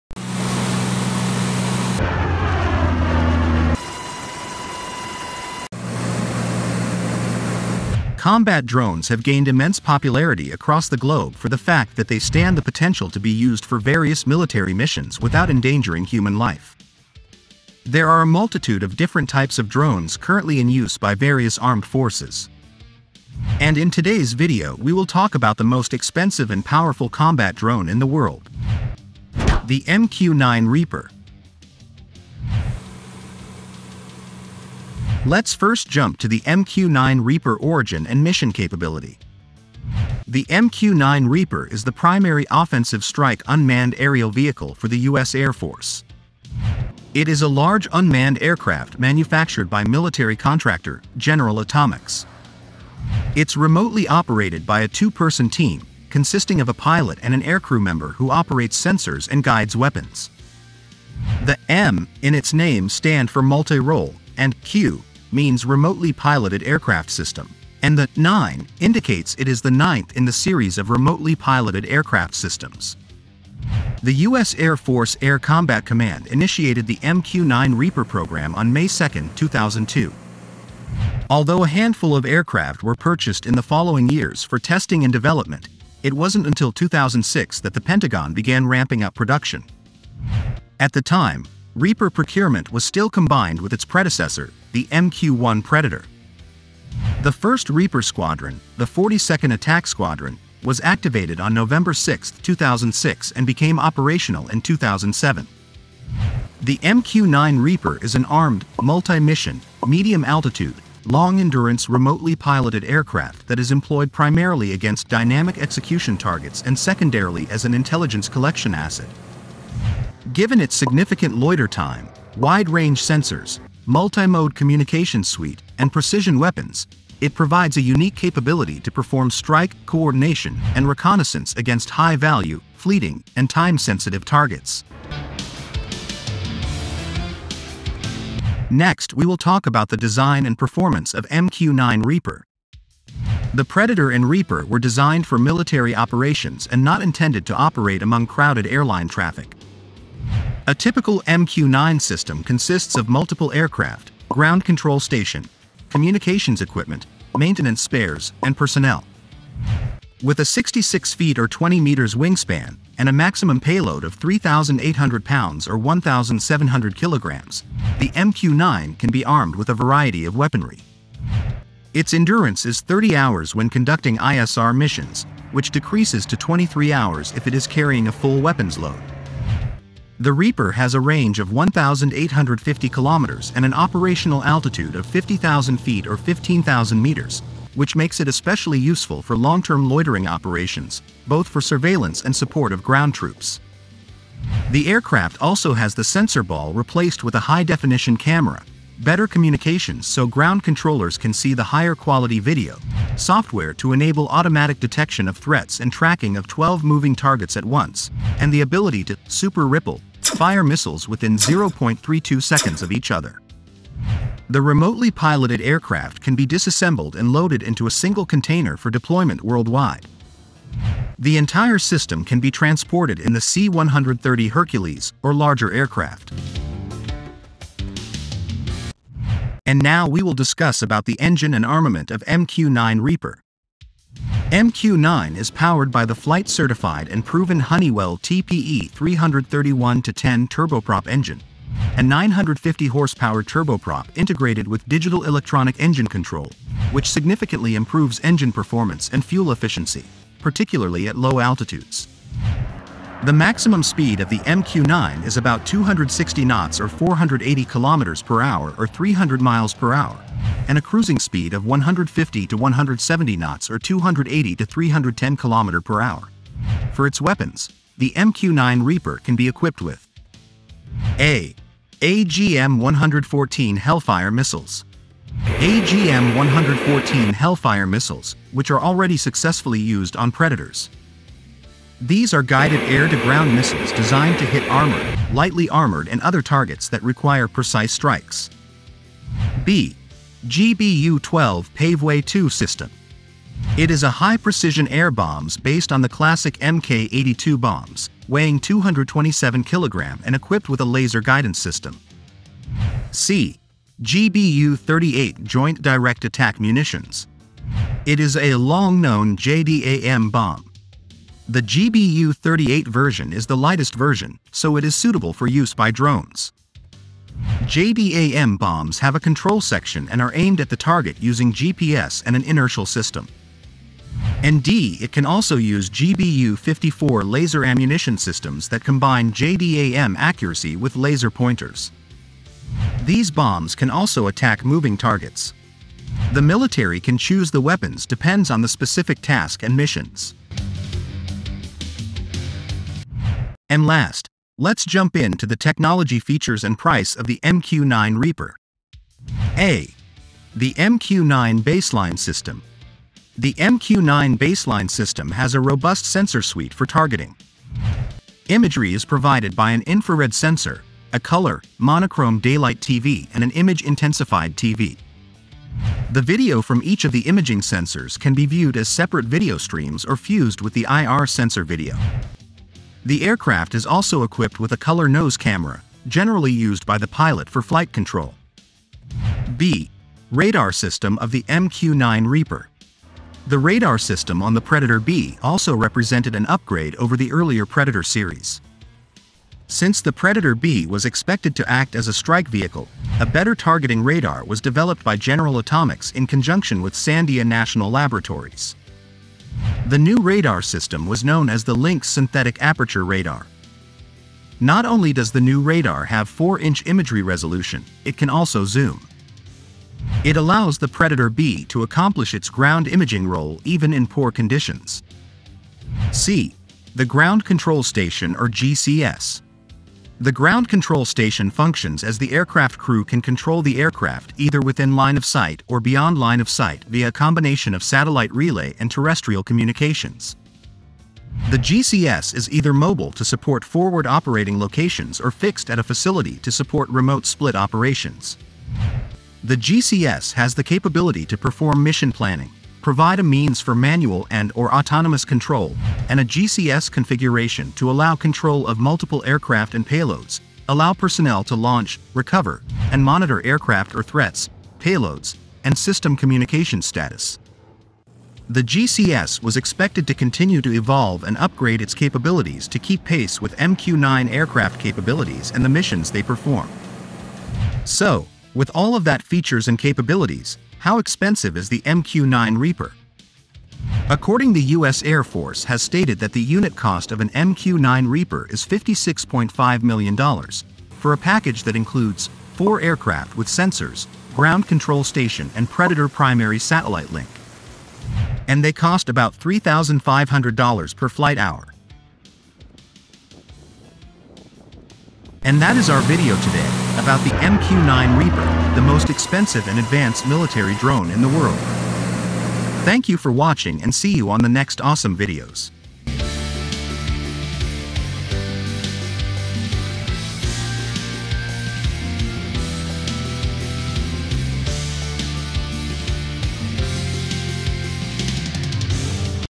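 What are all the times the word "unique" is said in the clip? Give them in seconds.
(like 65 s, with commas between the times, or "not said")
127 s.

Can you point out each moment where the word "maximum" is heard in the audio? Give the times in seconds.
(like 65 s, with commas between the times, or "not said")
163 s, 253 s.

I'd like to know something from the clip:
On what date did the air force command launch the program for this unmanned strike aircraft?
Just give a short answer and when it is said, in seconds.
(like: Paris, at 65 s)
May 2, 2002, at 78 s.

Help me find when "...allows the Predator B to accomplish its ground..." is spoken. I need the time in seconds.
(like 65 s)
410 s.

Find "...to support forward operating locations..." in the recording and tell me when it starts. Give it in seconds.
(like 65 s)
433 s.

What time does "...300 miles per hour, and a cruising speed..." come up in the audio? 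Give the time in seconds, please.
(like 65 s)
258 s.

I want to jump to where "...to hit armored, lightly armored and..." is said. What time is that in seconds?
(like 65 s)
284 s.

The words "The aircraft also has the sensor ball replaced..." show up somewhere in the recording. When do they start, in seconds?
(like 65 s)
194 s.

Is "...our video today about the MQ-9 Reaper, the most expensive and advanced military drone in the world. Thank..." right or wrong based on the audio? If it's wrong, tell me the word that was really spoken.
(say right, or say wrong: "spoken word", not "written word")
right.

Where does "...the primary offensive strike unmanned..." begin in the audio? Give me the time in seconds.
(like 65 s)
41 s.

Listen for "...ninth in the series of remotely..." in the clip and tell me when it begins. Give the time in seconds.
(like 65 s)
69 s.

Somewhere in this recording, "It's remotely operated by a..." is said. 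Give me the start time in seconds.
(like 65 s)
53 s.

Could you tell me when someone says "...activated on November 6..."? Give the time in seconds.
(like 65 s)
100 s.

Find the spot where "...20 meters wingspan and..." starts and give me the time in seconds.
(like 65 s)
161 s.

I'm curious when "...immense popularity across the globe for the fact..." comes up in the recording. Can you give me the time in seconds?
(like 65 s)
9 s.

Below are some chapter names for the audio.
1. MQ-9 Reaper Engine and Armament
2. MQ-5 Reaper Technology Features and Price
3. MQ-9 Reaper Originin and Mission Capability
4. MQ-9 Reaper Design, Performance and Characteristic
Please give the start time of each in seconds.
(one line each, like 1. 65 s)
1. 228 s
2. 342 s
3. 34 s
4. 138 s.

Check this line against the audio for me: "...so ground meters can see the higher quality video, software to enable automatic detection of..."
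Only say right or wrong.
wrong.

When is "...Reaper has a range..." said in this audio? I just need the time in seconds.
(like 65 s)
180 s.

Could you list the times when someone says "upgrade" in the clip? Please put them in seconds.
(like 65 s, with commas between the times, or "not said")
386 s, 461 s.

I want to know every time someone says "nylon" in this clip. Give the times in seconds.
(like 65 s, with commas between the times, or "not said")
not said.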